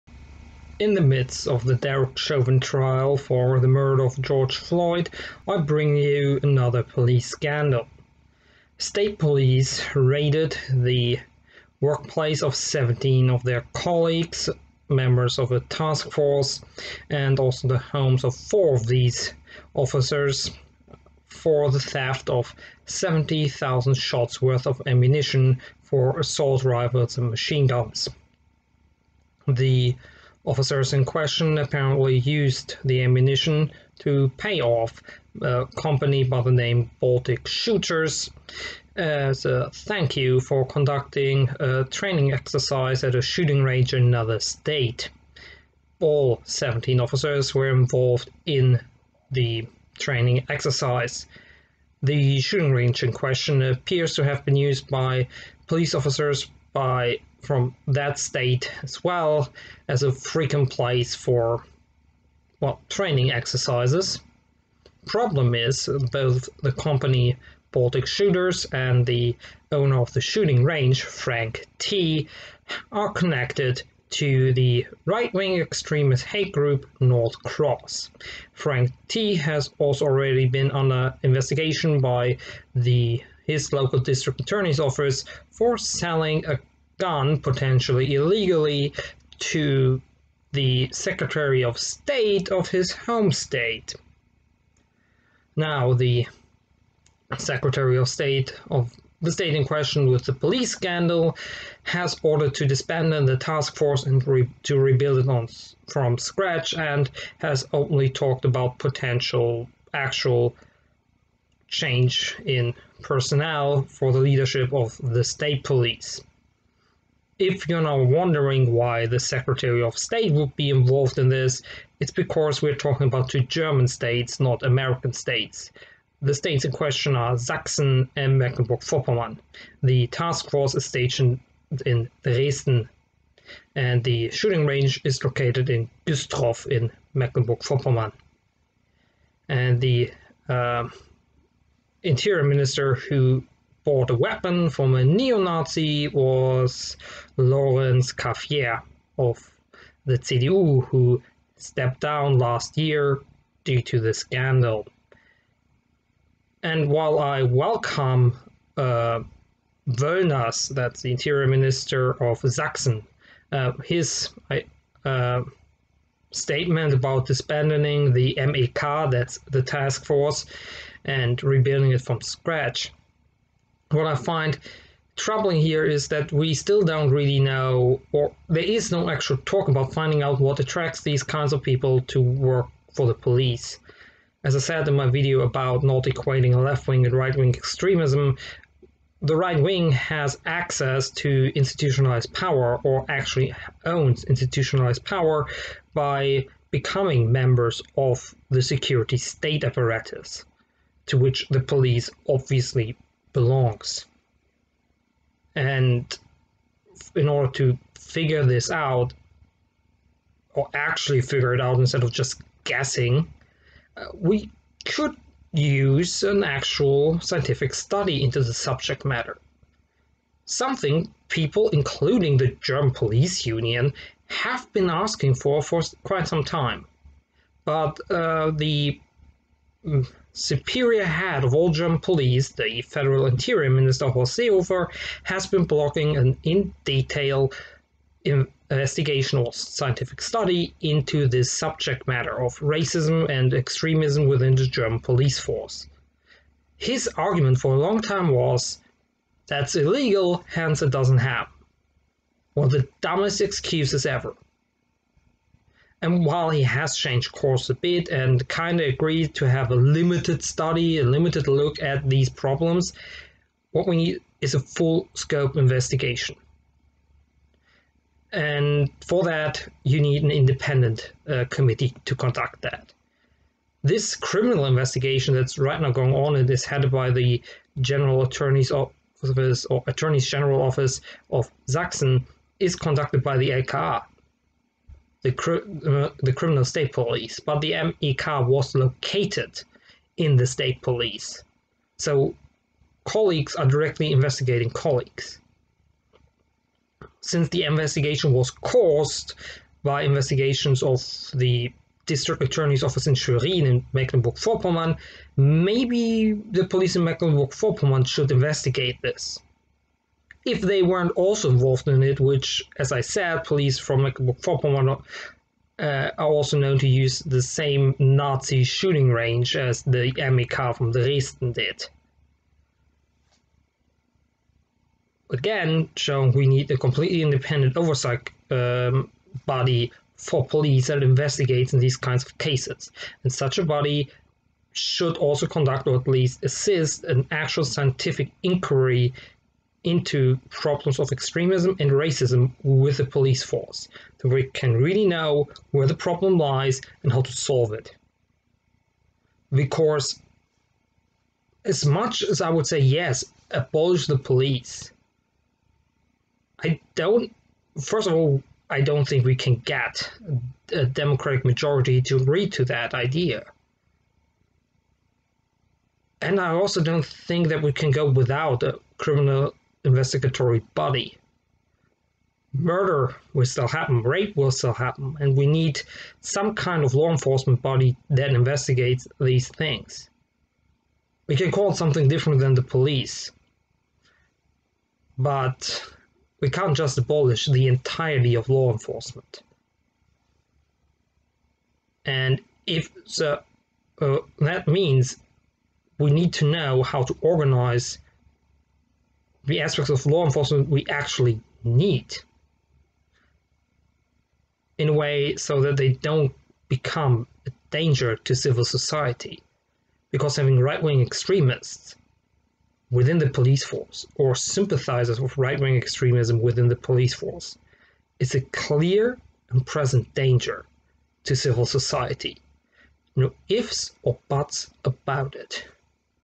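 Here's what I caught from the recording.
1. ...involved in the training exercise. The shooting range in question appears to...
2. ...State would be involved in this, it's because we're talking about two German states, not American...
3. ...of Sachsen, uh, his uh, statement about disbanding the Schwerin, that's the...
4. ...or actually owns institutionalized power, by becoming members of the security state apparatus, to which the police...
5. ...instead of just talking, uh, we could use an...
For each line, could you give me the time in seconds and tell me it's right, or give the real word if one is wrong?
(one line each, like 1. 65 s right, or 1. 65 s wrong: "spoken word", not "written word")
1. 47 s right
2. 119 s right
3. 162 s wrong: "MEK", not "Schwerin"
4. 192 s right
5. 211 s wrong: "guessing", not "talking".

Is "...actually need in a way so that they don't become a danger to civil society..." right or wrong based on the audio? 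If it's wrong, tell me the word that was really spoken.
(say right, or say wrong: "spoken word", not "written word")
right.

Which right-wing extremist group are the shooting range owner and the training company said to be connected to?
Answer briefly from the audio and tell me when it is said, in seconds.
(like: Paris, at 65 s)
North Cross, at 76 s.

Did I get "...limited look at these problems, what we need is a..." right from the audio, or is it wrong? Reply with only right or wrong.
right.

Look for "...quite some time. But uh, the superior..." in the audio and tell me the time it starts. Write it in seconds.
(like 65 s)
226 s.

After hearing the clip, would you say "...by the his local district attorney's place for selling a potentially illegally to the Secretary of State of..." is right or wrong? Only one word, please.
wrong.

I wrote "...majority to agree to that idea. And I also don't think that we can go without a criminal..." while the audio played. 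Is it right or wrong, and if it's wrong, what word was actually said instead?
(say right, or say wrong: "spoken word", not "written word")
right.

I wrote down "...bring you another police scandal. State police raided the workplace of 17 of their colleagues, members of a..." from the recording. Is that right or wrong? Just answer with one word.
right.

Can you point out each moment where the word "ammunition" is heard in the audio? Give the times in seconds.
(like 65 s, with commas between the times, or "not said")
24 s, 33 s.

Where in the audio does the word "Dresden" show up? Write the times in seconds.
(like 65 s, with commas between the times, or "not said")
132 s, 320 s.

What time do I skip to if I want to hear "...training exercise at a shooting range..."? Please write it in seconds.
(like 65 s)
41 s.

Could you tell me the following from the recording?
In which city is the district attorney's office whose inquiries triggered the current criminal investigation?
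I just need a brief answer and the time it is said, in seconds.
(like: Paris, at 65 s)
Schwerin, at 303 s.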